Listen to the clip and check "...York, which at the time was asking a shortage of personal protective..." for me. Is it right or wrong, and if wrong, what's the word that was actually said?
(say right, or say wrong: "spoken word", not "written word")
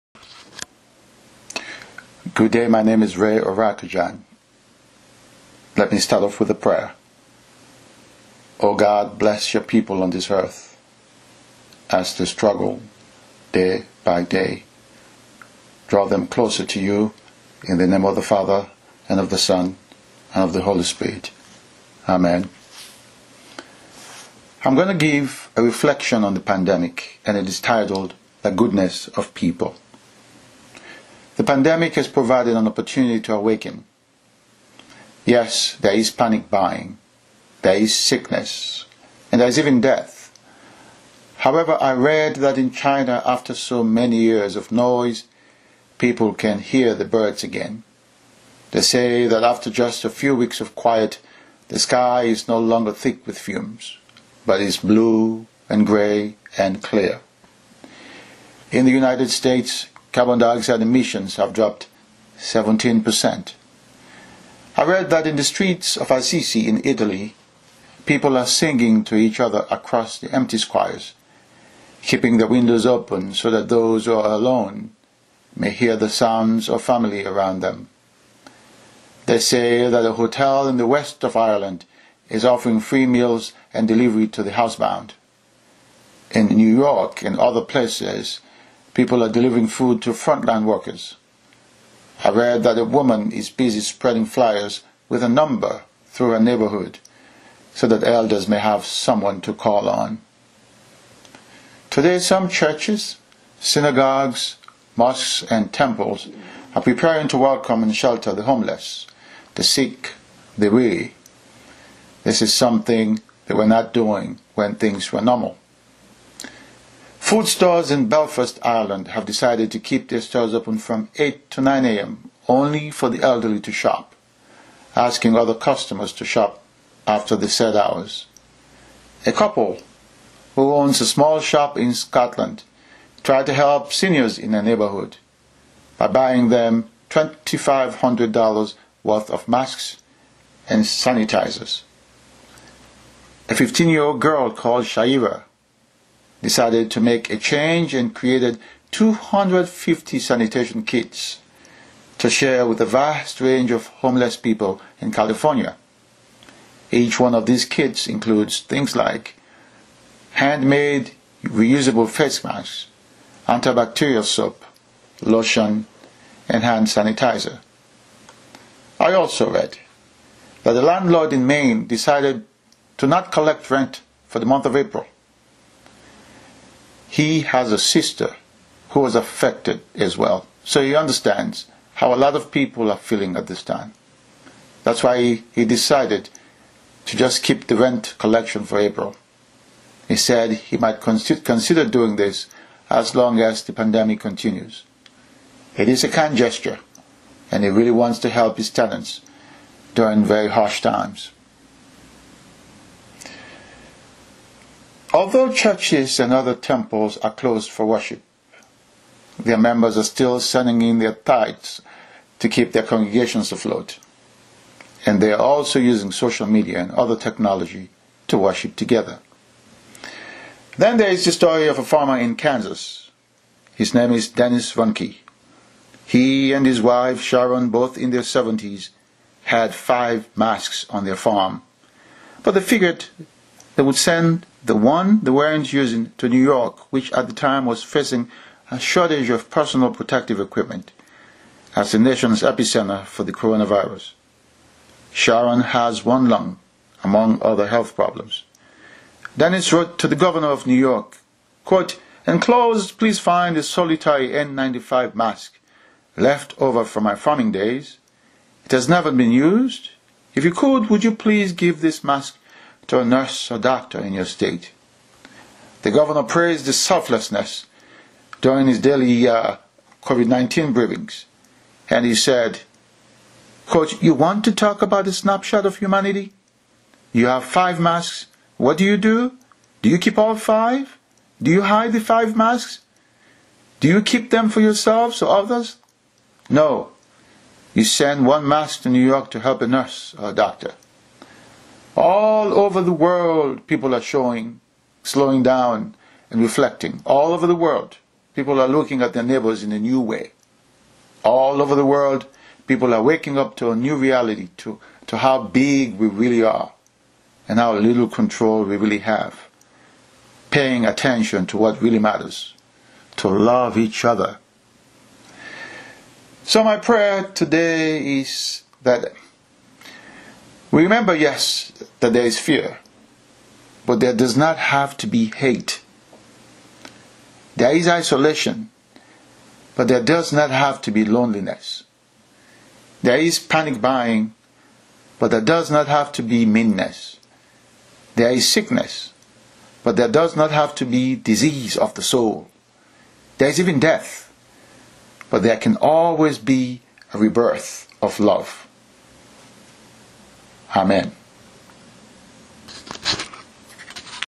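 wrong: "facing", not "asking".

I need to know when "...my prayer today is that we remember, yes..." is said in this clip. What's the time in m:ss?
5:16.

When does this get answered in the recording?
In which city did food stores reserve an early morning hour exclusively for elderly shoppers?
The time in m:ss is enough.
1:58.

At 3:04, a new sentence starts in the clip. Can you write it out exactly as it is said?
That's why he, he decided to just keep the rent collection for April.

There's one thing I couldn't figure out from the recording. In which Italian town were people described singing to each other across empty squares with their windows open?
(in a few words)
Assisi.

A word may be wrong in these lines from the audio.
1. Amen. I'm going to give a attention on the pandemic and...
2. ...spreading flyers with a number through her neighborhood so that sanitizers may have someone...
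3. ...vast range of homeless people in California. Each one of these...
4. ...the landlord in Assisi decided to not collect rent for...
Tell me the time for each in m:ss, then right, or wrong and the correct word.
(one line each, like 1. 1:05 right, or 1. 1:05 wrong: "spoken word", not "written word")
1. 0:22 wrong: "reflection", not "attention"
2. 1:33 wrong: "elders", not "sanitizers"
3. 2:32 right
4. 2:50 wrong: "Maine", not "Assisi".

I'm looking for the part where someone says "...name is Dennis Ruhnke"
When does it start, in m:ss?
3:43.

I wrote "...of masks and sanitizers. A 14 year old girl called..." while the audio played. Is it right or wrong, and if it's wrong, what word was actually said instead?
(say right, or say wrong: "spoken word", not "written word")
wrong: "15", not "14".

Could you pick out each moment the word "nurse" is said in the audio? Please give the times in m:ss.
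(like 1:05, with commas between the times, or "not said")
4:23, 4:49.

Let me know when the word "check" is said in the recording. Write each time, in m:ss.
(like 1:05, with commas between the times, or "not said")
not said.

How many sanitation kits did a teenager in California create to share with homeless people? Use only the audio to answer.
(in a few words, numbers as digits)
250.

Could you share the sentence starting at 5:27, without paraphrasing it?
There is isolation, but there does not have to be loneliness.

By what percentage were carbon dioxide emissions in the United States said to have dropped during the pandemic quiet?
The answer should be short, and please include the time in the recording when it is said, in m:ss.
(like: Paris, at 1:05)
17%, at 1:02.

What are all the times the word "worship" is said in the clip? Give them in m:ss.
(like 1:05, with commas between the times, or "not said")
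3:27, 3:38.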